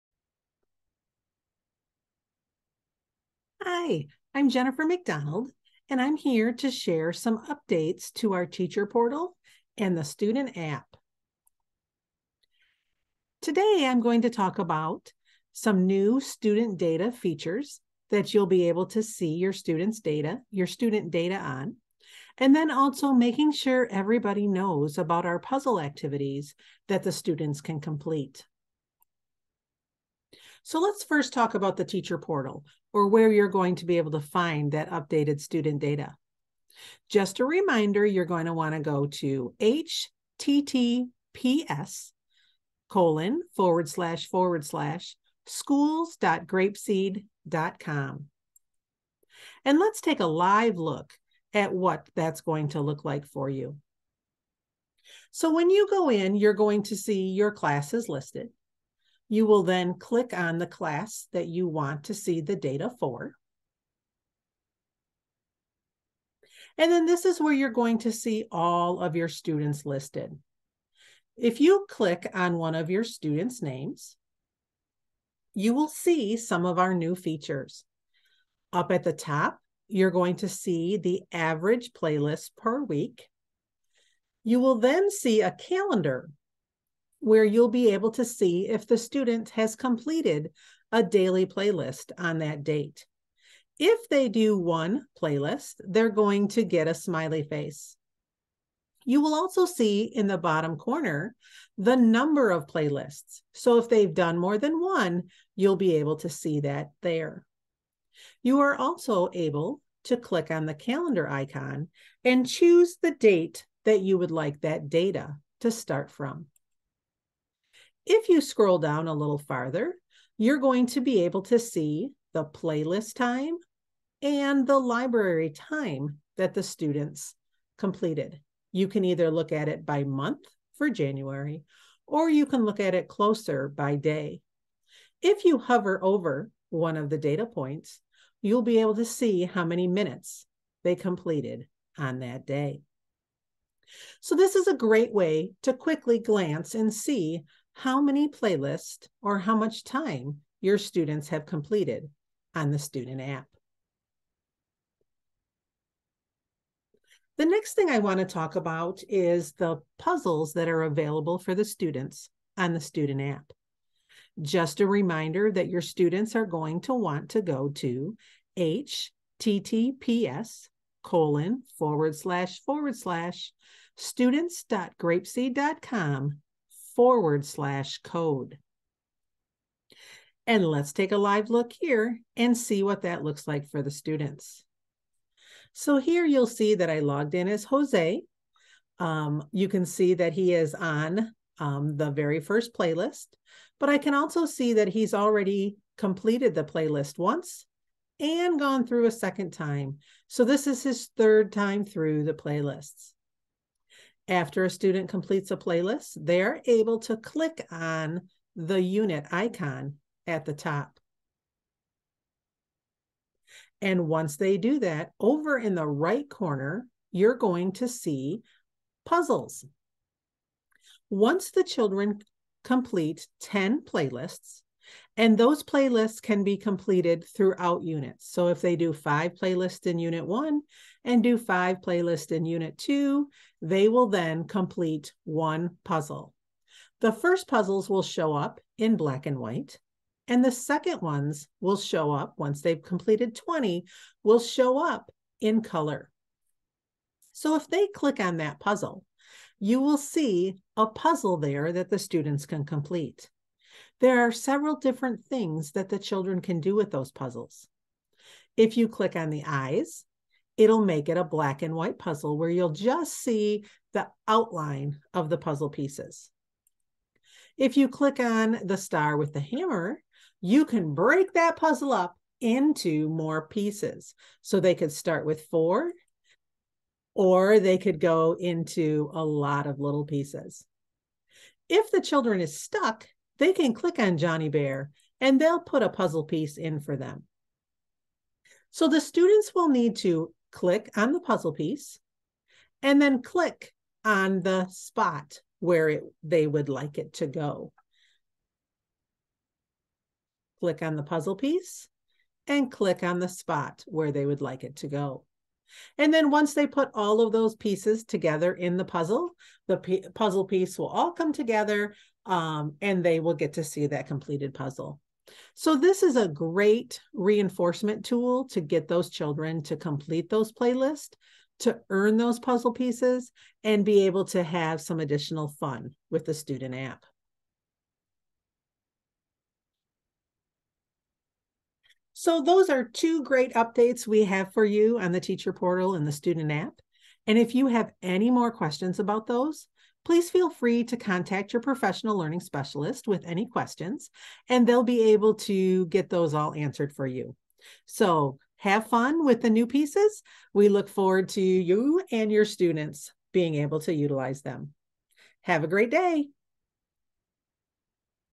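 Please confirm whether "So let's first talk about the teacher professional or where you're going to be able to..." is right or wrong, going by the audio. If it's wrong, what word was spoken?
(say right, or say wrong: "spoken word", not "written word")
wrong: "portal", not "professional".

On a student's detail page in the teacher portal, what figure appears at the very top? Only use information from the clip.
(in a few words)
Average playlist per week.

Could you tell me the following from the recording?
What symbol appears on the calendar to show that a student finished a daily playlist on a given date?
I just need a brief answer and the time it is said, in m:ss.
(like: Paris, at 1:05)
Smiley face, at 1:36.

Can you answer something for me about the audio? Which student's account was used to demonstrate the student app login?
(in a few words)
Jose.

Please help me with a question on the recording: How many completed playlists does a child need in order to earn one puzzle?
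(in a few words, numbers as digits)
10.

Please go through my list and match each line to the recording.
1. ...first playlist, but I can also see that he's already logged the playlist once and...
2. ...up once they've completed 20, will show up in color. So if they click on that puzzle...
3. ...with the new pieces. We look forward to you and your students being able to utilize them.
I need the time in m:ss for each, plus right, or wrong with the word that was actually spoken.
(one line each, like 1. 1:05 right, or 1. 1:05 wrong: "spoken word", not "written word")
1. 3:12 wrong: "completed", not "logged"
2. 4:02 right
3. 5:49 right.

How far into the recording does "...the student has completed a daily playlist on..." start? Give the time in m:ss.
1:28.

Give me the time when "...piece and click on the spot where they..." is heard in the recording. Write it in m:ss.
5:01.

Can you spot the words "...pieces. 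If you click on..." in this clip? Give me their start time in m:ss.
4:25.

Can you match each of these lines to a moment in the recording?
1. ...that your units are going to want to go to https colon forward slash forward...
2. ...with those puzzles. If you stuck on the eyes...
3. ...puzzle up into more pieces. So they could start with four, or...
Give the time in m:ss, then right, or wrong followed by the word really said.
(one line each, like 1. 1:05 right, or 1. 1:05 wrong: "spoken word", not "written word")
1. 2:45 wrong: "students", not "units"
2. 4:16 wrong: "click", not "stuck"
3. 4:31 right.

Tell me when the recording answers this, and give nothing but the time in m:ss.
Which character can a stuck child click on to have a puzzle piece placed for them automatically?
4:44.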